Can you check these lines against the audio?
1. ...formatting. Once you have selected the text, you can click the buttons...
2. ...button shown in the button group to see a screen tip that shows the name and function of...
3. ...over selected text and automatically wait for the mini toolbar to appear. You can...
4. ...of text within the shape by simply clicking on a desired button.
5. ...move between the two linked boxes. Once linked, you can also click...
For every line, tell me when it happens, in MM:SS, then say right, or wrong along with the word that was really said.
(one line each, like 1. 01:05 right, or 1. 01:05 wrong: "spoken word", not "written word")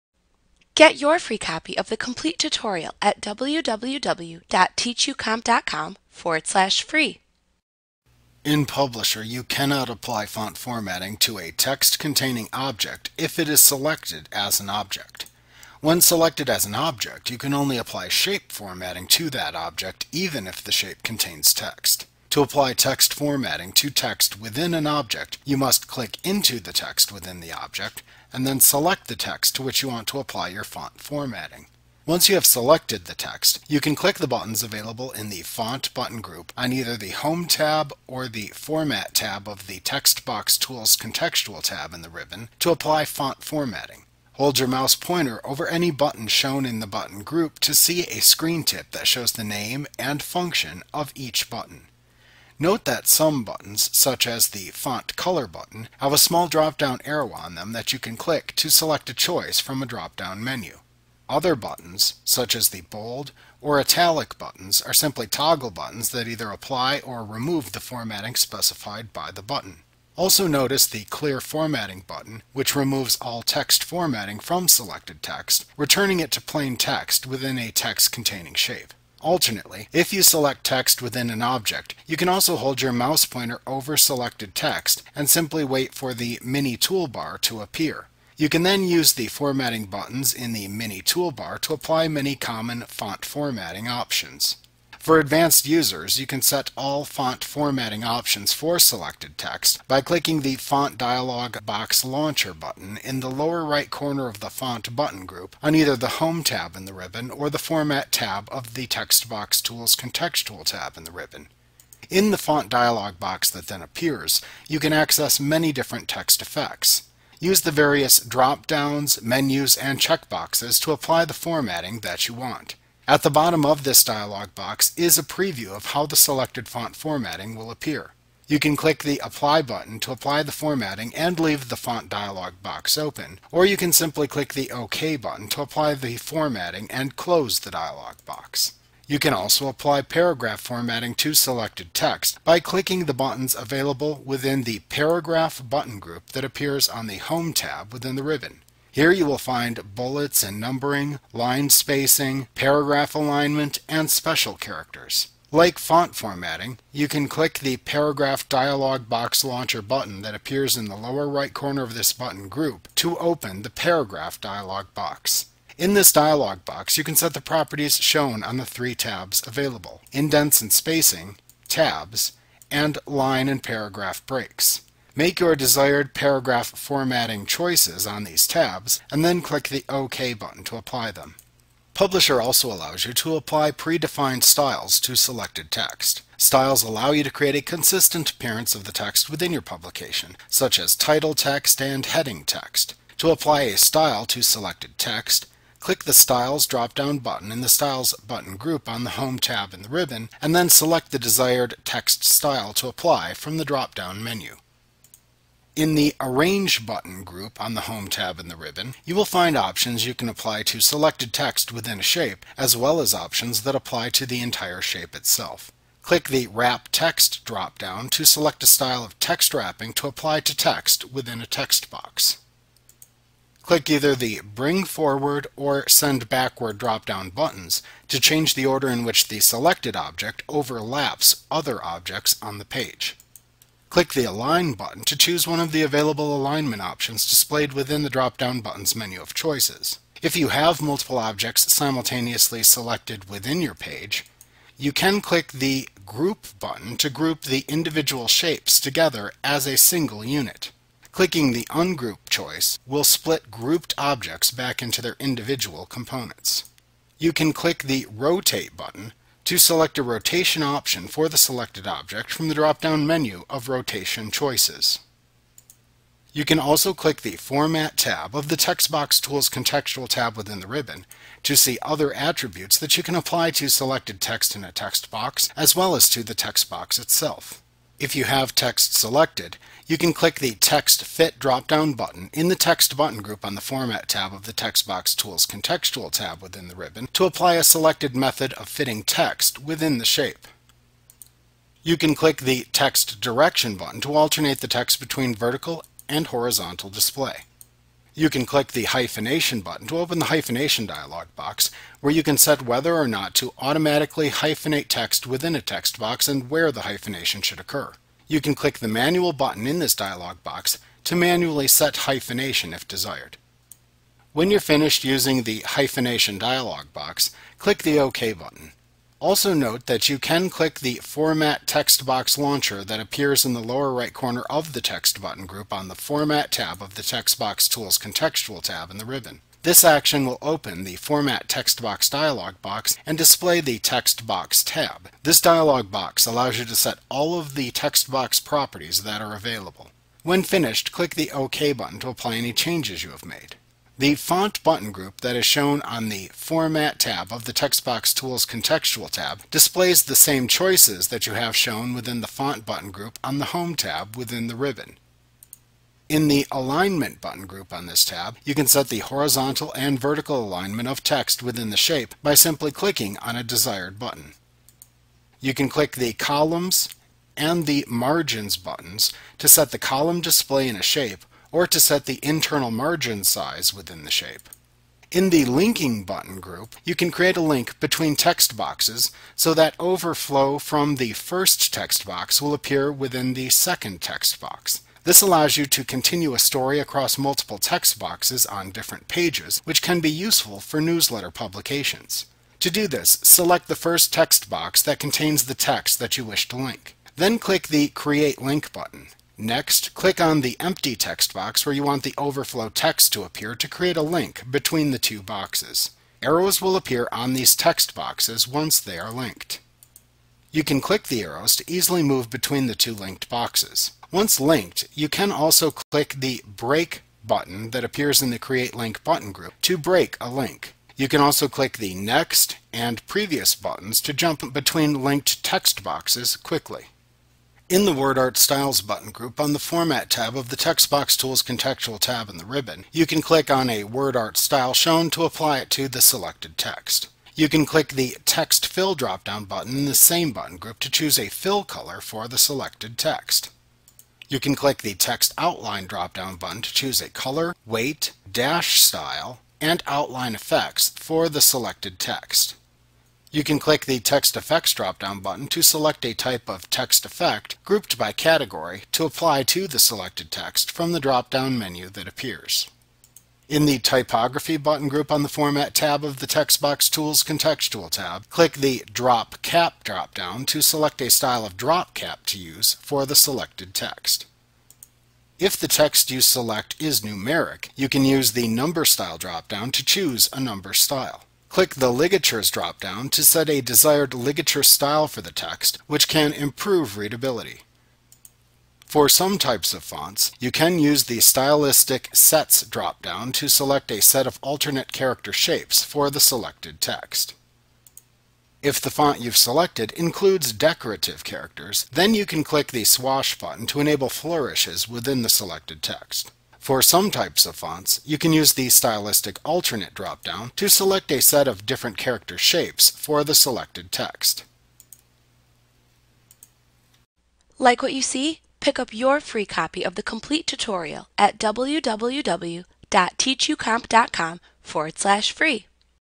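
1. 00:31 right
2. 00:45 right
3. 01:23 wrong: "simply", not "automatically"
4. 06:00 right
5. 06:52 right.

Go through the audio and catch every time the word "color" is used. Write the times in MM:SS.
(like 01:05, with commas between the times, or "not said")
00:55, 07:21, 07:27.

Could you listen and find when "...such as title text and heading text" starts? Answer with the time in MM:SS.
03:10.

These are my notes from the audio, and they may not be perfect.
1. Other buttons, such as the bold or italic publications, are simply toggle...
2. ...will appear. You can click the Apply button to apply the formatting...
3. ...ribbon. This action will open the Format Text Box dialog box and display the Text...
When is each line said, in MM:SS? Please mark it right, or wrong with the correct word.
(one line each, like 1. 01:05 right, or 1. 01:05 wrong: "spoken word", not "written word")
1. 01:01 wrong: "buttons", not "publications"
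2. 02:07 right
3. 05:29 right.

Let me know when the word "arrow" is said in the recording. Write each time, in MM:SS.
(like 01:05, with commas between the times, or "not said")
00:57, 06:46, 06:51.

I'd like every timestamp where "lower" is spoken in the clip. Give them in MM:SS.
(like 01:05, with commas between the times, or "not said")
01:43, 02:40, 05:23.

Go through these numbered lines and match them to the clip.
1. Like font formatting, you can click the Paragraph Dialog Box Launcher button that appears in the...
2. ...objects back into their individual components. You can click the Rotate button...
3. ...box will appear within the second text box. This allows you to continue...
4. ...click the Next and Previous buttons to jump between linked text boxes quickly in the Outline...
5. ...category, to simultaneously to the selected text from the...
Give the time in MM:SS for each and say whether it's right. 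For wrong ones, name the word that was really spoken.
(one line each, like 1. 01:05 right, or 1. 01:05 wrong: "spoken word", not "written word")
1. 02:35 right
2. 04:13 right
3. 06:22 right
4. 07:01 wrong: "WordArt", not "Outline"
5. 07:38 wrong: "apply", not "simultaneously".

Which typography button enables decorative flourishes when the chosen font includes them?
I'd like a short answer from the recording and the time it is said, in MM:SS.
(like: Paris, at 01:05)
Swash, at 08:22.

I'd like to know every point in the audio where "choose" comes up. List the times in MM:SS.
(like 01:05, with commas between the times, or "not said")
03:55, 07:20, 07:26, 07:59.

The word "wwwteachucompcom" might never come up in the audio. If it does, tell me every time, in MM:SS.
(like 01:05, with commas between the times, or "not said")
00:03, 08:41.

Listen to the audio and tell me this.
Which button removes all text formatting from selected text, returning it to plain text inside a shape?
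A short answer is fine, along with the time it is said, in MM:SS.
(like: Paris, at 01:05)
Clear Formatting, at 01:11.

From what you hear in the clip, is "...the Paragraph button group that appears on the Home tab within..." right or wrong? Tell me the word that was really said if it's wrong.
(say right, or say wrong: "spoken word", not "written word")
right.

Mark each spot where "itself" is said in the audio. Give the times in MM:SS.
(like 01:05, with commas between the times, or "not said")
03:35, 04:36.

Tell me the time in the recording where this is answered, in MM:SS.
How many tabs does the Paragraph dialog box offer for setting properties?
02:48.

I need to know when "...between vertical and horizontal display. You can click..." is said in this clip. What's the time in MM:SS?
04:54.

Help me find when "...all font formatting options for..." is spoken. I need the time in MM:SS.
01:36.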